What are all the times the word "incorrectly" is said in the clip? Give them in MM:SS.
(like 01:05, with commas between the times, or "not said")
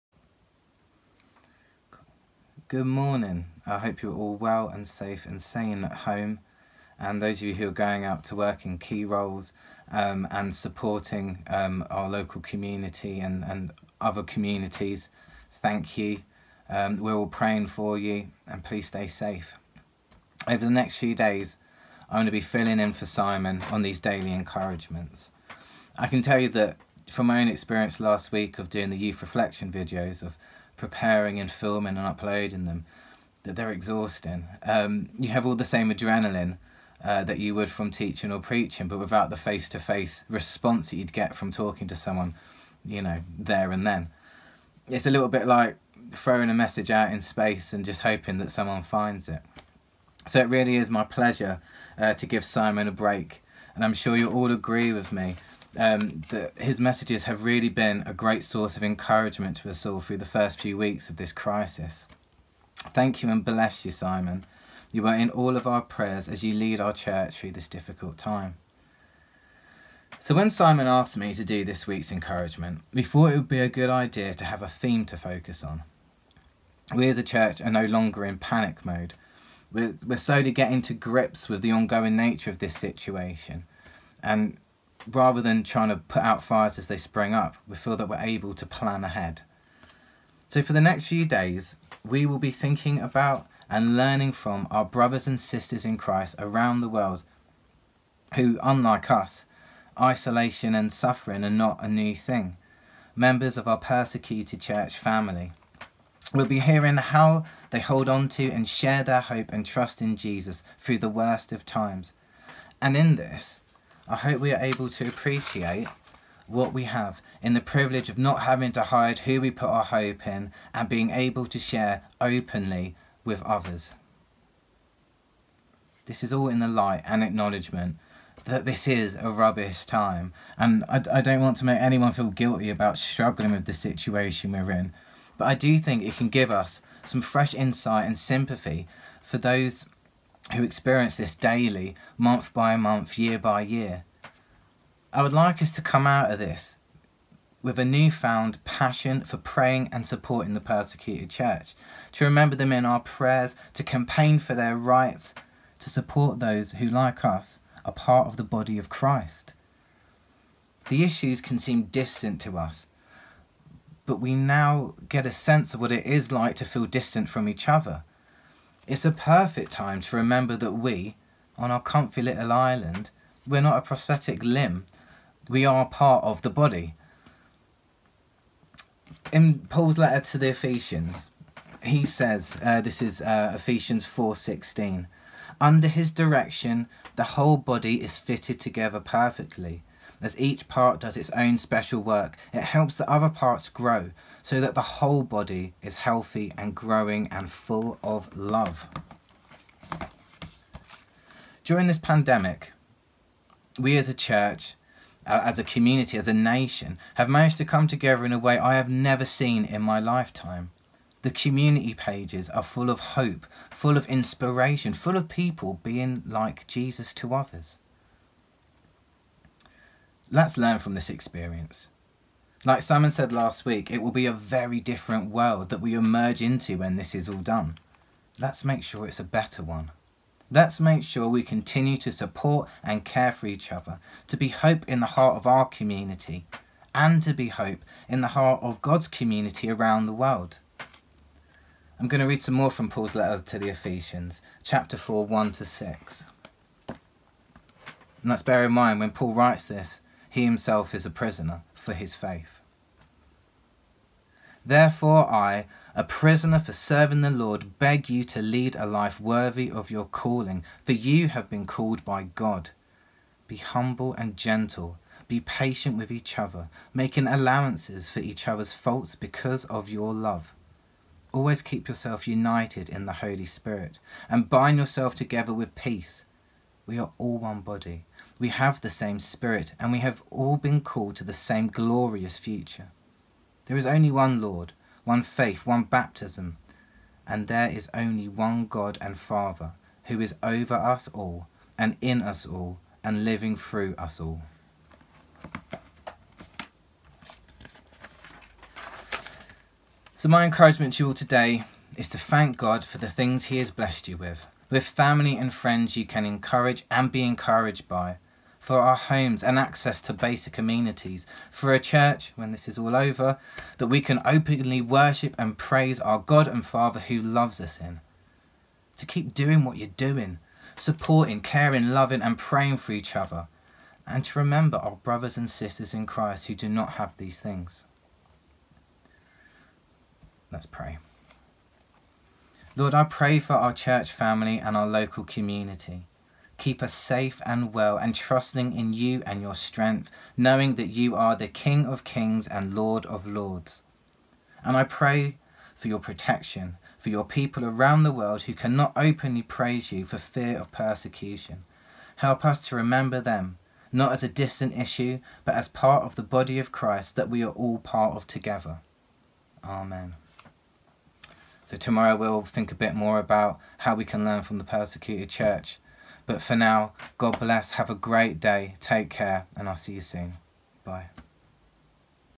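not said.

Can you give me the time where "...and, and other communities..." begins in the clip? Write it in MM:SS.
00:13.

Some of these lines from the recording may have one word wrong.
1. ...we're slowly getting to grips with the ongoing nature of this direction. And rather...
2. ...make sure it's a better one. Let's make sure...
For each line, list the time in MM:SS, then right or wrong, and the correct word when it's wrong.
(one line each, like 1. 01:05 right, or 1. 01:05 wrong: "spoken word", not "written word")
1. 01:20 wrong: "situation", not "direction"
2. 03:48 right.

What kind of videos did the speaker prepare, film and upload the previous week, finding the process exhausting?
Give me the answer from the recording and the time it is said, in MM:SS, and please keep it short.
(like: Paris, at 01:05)
youth reflection videos, at 00:28.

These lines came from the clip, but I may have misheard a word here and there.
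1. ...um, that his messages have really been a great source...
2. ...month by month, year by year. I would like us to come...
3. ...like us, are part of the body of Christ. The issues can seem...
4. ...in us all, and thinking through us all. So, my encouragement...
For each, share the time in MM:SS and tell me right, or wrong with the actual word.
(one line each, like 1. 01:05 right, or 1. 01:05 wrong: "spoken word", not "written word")
1. 00:55 right
2. 02:22 right
3. 02:36 right
4. 04:52 wrong: "living", not "thinking".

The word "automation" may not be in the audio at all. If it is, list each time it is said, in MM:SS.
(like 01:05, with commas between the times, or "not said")
not said.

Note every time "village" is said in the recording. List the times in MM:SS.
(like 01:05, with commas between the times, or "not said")
not said.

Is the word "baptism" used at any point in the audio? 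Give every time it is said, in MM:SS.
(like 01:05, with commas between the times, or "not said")
04:45.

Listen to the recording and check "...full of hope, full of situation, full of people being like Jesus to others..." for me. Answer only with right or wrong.
wrong.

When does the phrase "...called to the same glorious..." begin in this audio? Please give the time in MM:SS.
04:40.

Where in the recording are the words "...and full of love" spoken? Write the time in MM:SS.
03:17.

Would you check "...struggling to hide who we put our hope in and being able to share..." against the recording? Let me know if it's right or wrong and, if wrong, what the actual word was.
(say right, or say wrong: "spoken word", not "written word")
wrong: "having", not "struggling".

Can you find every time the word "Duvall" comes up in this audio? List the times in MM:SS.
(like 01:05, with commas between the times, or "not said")
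not said.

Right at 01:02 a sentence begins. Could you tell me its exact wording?
Thank you and bless you, Simon.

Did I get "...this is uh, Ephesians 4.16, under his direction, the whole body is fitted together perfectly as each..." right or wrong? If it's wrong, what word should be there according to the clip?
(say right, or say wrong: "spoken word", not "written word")
right.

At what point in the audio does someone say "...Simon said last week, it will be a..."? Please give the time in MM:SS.
03:42.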